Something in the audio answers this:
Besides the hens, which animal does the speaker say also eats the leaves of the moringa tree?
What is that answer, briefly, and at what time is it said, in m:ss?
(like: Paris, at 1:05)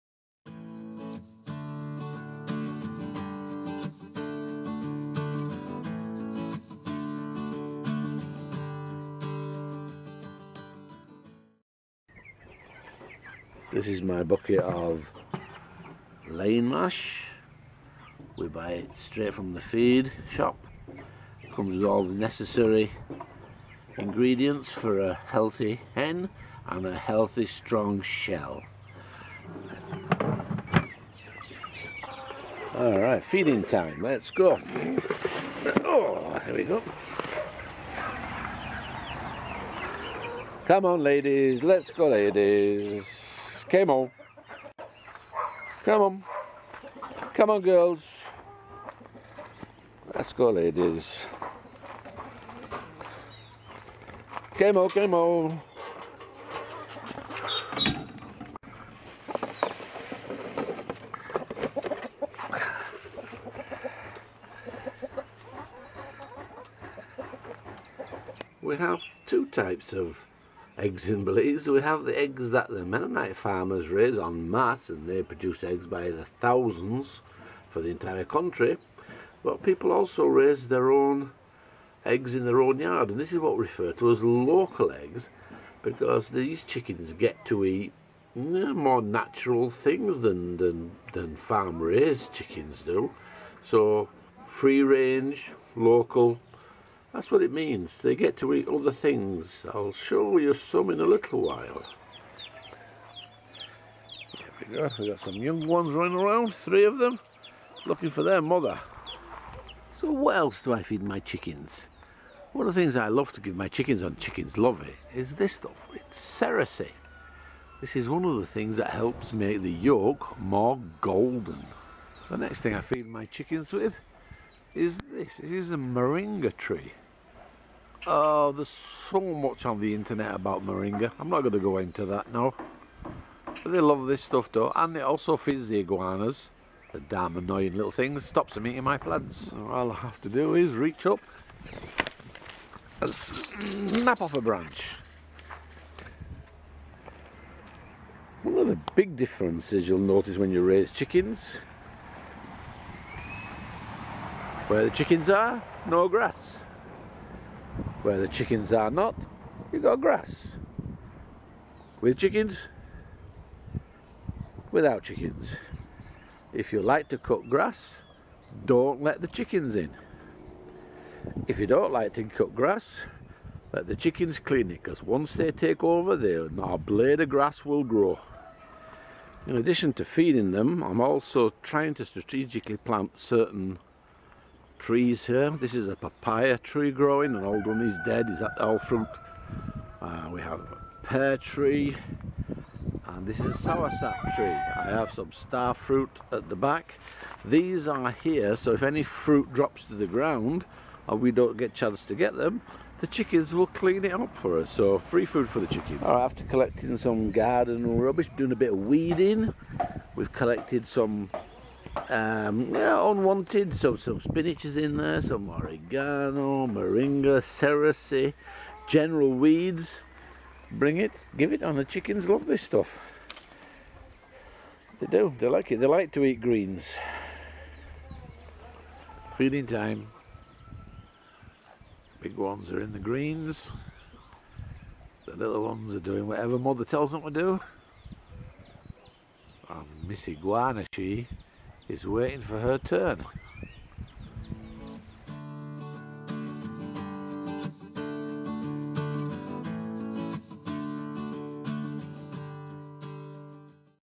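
Iguanas, at 2:15.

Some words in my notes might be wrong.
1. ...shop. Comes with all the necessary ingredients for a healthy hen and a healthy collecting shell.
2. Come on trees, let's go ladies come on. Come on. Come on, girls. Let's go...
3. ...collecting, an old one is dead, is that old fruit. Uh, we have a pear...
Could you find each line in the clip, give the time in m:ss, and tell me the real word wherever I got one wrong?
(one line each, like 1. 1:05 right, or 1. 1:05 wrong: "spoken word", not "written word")
1. 0:20 wrong: "strong", not "collecting"
2. 0:40 wrong: "ladies", not "trees"
3. 3:06 wrong: "growing", not "collecting".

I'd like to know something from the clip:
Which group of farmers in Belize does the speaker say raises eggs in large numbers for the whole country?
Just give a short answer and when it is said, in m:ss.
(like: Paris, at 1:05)
Mennonite farmers, at 1:12.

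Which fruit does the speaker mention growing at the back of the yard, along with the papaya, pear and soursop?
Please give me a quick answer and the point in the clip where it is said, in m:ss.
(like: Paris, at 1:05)
Star fruit, at 3:15.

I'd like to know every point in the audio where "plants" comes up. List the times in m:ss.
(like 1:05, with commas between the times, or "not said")
2:18, 3:02.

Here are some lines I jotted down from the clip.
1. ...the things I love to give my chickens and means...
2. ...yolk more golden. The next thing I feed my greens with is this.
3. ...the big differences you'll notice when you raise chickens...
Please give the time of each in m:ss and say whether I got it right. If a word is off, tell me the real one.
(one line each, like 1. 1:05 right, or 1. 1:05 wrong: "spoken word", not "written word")
1. 1:52 wrong: "chickens", not "means"
2. 1:59 wrong: "chickens", not "greens"
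3. 2:28 right.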